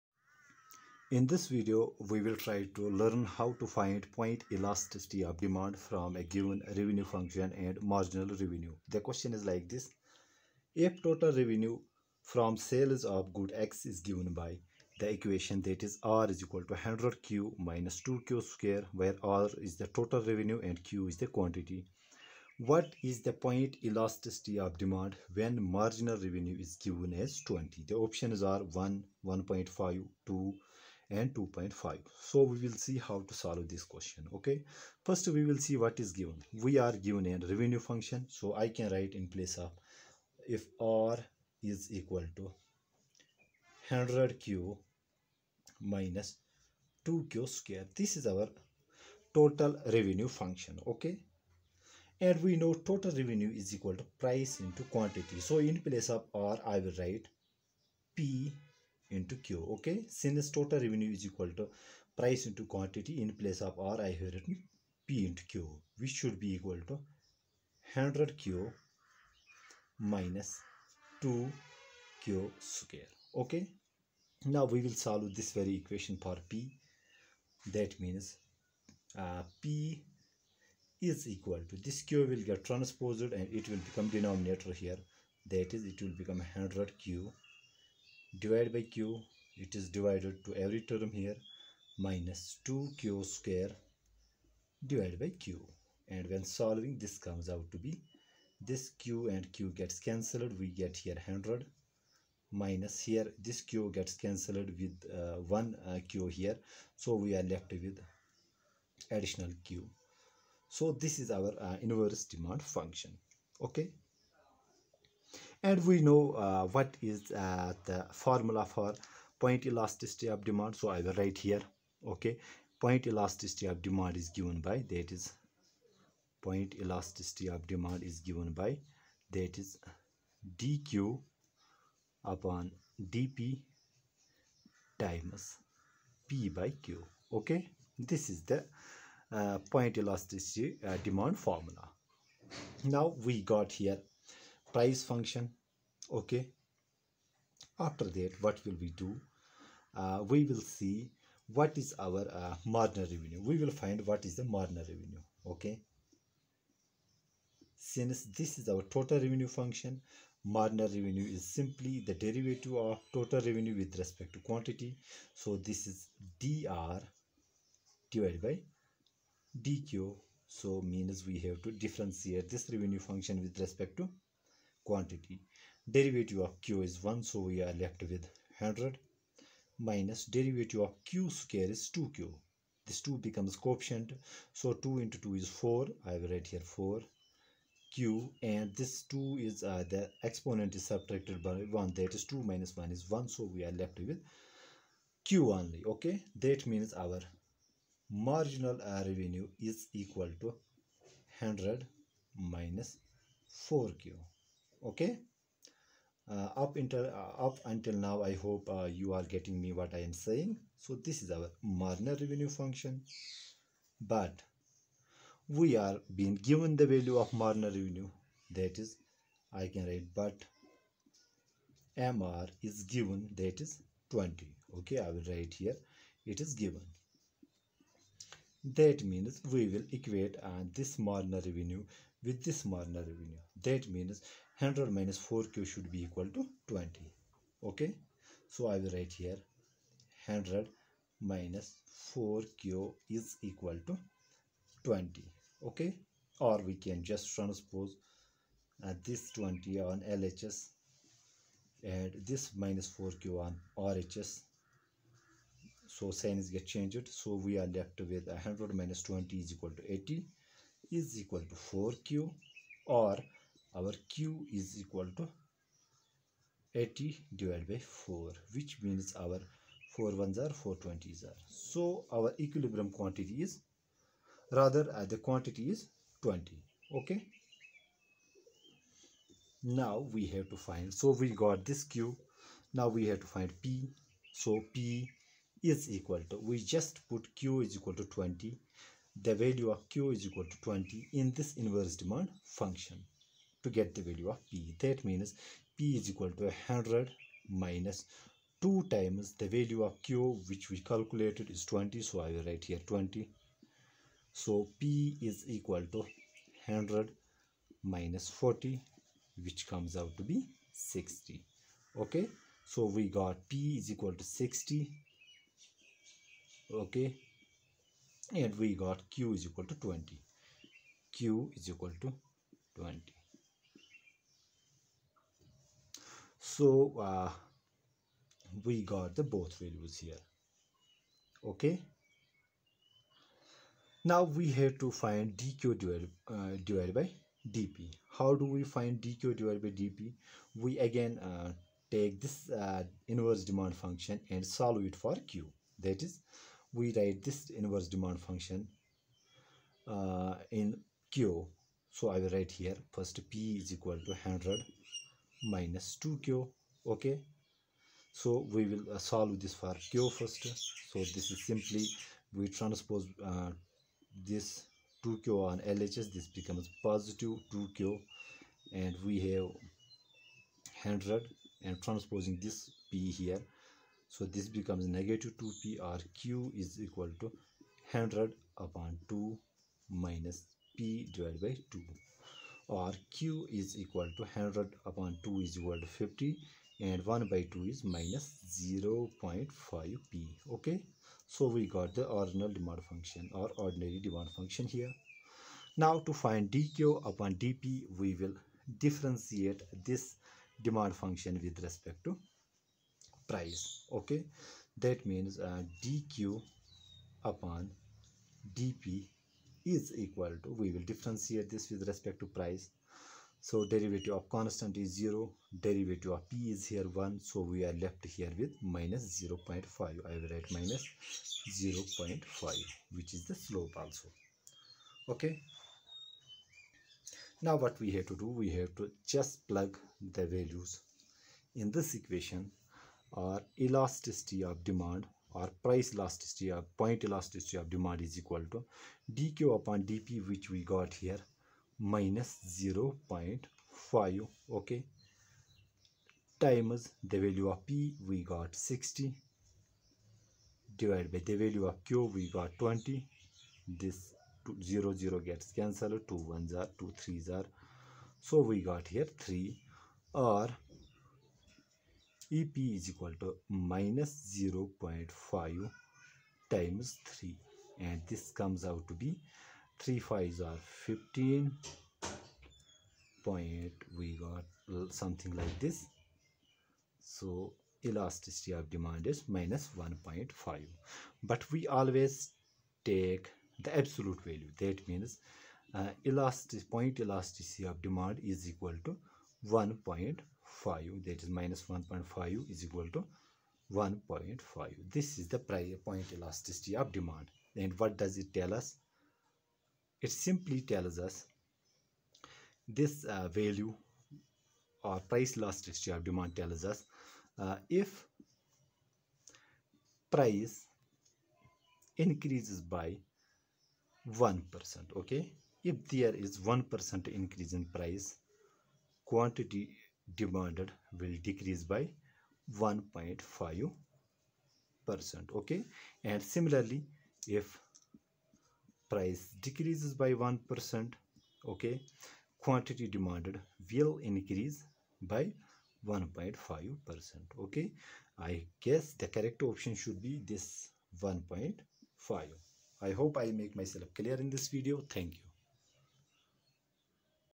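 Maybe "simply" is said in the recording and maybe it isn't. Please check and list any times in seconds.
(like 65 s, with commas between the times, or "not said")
161 s, 361 s, 500 s.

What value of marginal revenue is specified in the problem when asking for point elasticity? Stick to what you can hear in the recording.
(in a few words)
20.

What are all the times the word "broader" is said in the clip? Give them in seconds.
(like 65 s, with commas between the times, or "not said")
not said.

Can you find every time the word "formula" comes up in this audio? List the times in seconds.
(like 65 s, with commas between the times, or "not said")
118 s, 141 s.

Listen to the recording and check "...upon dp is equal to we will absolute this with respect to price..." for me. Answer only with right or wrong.
wrong.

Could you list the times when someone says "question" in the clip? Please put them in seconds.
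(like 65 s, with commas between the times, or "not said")
9 s, 33 s.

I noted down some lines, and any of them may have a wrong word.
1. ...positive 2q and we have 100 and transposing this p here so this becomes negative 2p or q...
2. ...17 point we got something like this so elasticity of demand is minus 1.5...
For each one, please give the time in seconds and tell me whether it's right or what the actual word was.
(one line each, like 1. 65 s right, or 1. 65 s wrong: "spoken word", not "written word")
1. 366 s right
2. 470 s wrong: "15", not "17".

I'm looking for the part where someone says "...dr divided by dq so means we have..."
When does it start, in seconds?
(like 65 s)
166 s.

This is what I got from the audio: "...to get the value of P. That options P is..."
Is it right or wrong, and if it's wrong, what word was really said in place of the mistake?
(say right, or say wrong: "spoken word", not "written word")
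wrong: "means", not "options".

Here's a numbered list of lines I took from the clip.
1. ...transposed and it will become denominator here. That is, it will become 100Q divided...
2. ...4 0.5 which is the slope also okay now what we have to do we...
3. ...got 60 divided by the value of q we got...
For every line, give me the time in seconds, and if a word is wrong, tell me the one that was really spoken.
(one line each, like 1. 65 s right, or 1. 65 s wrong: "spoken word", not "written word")
1. 82 s right
2. 421 s wrong: "0", not "4"
3. 448 s right.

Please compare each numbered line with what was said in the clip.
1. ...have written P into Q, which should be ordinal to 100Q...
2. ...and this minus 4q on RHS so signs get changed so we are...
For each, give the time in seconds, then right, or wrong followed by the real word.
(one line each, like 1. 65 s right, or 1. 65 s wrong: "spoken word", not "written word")
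1. 64 s wrong: "equal", not "ordinal"
2. 251 s right.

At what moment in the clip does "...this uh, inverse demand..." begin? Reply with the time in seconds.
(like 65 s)
342 s.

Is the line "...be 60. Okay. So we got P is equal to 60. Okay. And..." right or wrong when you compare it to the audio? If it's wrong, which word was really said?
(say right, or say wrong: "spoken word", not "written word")
right.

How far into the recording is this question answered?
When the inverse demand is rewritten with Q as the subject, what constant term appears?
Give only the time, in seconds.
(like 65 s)
385 s.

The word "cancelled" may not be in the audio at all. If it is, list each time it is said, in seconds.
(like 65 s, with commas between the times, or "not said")
99 s, 104 s, 455 s.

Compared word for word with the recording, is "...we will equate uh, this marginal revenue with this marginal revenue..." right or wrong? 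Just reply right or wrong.
right.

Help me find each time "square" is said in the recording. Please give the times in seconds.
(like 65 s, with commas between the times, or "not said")
18 s, 47 s, 72 s, 93 s, 181 s.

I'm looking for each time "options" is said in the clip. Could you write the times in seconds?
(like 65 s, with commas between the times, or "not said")
27 s, 539 s.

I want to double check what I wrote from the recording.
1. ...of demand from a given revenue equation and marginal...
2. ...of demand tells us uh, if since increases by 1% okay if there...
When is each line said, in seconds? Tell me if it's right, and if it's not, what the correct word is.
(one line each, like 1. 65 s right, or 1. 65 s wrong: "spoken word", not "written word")
1. 5 s wrong: "function", not "equation"
2. 505 s wrong: "price", not "since".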